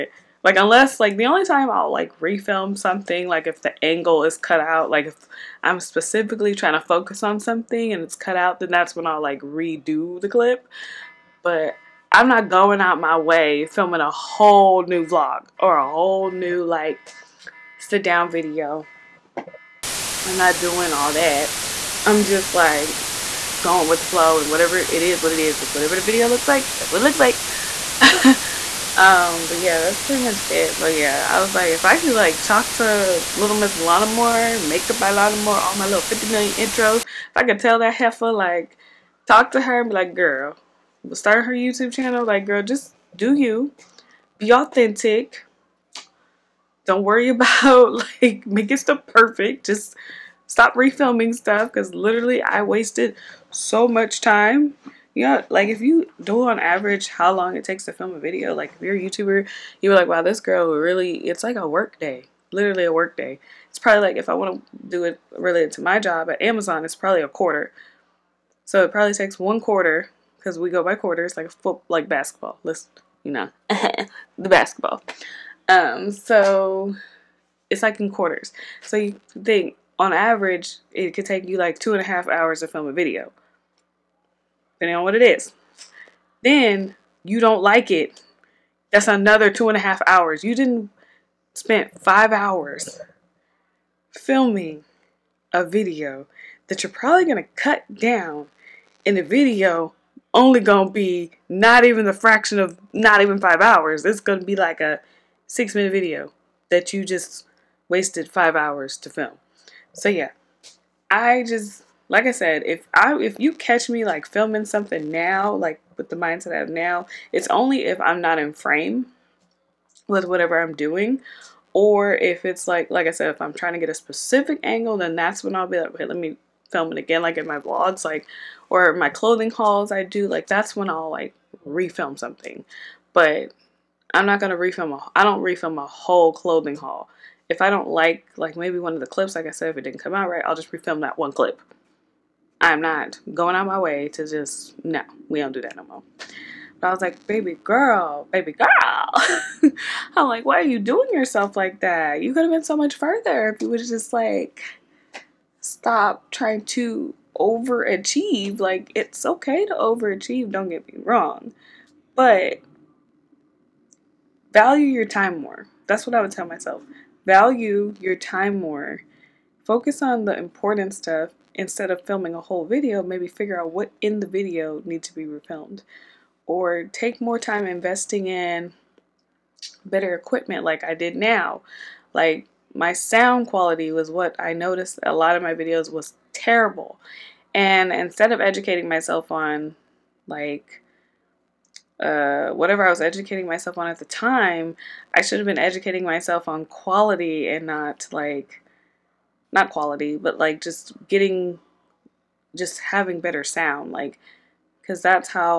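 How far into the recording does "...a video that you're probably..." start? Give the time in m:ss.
1:35.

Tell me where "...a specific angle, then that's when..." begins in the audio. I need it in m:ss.
2:03.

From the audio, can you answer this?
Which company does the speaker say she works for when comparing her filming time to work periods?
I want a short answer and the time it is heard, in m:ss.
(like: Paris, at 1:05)
Amazon, at 1:06.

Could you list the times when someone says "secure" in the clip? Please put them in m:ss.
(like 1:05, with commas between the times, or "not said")
not said.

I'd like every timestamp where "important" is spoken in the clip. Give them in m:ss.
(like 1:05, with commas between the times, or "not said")
2:50.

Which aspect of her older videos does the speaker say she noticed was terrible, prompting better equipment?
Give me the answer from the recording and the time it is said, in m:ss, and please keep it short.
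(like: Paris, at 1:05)
Sound quality, at 3:02.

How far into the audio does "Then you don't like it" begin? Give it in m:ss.
1:26.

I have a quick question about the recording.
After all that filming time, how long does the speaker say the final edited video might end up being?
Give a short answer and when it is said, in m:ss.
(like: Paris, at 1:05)
6 minutes, at 1:45.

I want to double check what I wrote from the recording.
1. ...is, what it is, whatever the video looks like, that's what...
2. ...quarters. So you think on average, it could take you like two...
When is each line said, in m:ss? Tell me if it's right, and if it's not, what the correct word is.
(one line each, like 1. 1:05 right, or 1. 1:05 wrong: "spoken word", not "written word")
1. 0:25 right
2. 1:18 right.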